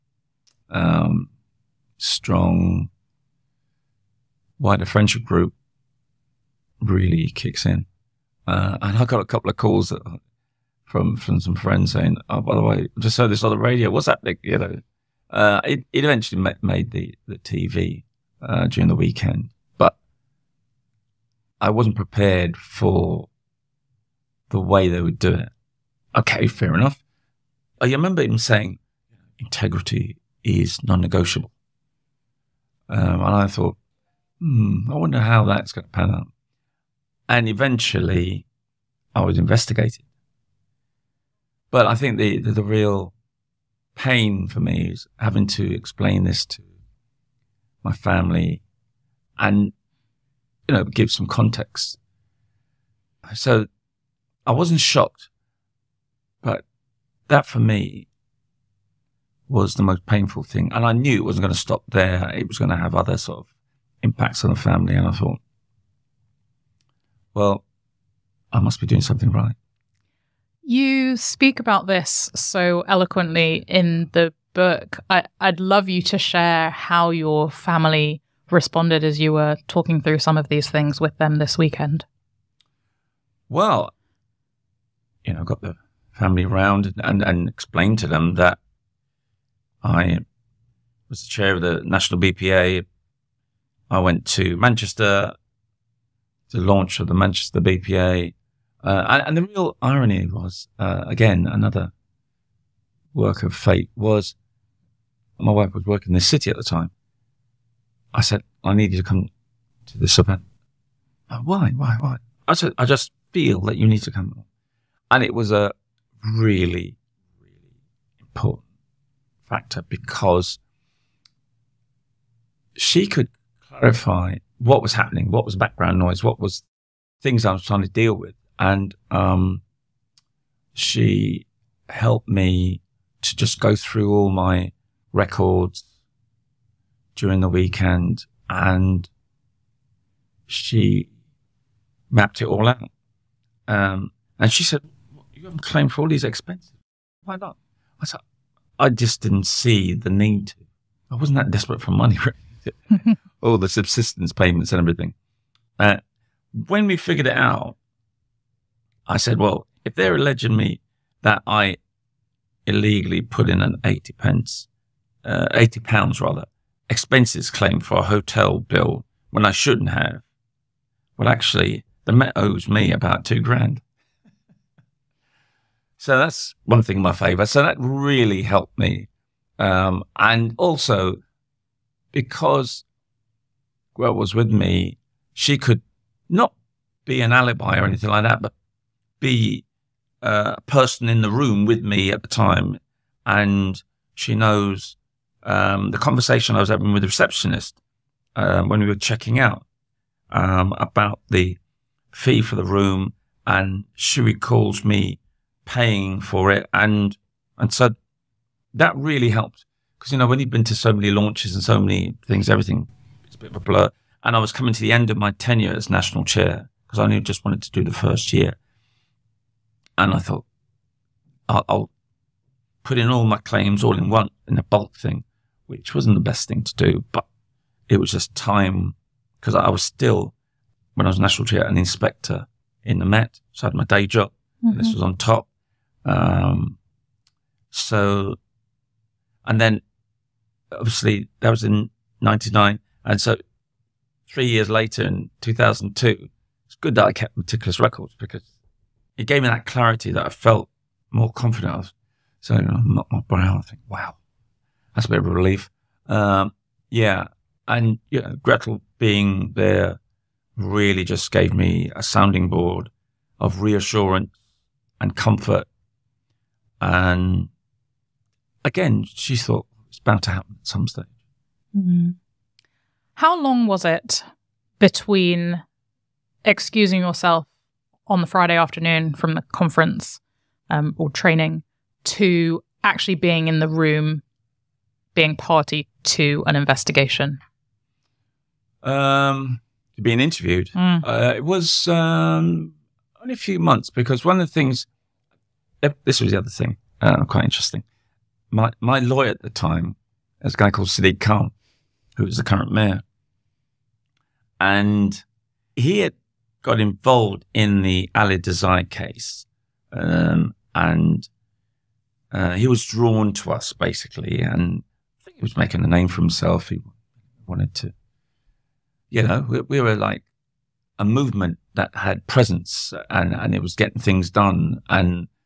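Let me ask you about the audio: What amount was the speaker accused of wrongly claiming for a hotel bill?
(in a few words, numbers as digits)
80 pounds.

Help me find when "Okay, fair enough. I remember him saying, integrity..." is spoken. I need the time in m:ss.
0:26.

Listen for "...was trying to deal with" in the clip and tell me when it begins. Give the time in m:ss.
2:07.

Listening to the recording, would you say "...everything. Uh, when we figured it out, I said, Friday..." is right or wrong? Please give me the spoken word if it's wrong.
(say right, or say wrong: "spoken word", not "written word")
wrong: "Well", not "Friday".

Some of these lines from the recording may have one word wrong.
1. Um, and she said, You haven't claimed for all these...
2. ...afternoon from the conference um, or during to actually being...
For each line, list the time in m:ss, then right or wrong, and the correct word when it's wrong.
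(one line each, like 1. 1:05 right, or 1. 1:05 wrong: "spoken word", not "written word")
1. 2:23 right
2. 4:38 wrong: "training", not "during".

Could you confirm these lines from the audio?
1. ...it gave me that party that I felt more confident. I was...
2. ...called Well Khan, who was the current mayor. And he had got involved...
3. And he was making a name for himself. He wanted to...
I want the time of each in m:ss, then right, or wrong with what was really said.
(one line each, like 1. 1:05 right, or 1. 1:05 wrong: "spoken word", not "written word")
1. 4:09 wrong: "clarity", not "party"
2. 5:00 wrong: "Sadiq", not "Well"
3. 5:14 right.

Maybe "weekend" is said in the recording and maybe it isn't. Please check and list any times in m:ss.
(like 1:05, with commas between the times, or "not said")
0:18, 1:21, 2:17.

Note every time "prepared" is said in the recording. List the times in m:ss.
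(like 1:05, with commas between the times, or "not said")
0:21.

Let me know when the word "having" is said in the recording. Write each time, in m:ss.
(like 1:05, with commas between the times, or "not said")
0:45, 3:16.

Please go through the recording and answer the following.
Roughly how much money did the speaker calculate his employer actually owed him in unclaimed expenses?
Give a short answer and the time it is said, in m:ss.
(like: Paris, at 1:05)
About two grand, at 2:52.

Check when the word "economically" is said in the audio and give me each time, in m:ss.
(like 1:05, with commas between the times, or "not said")
not said.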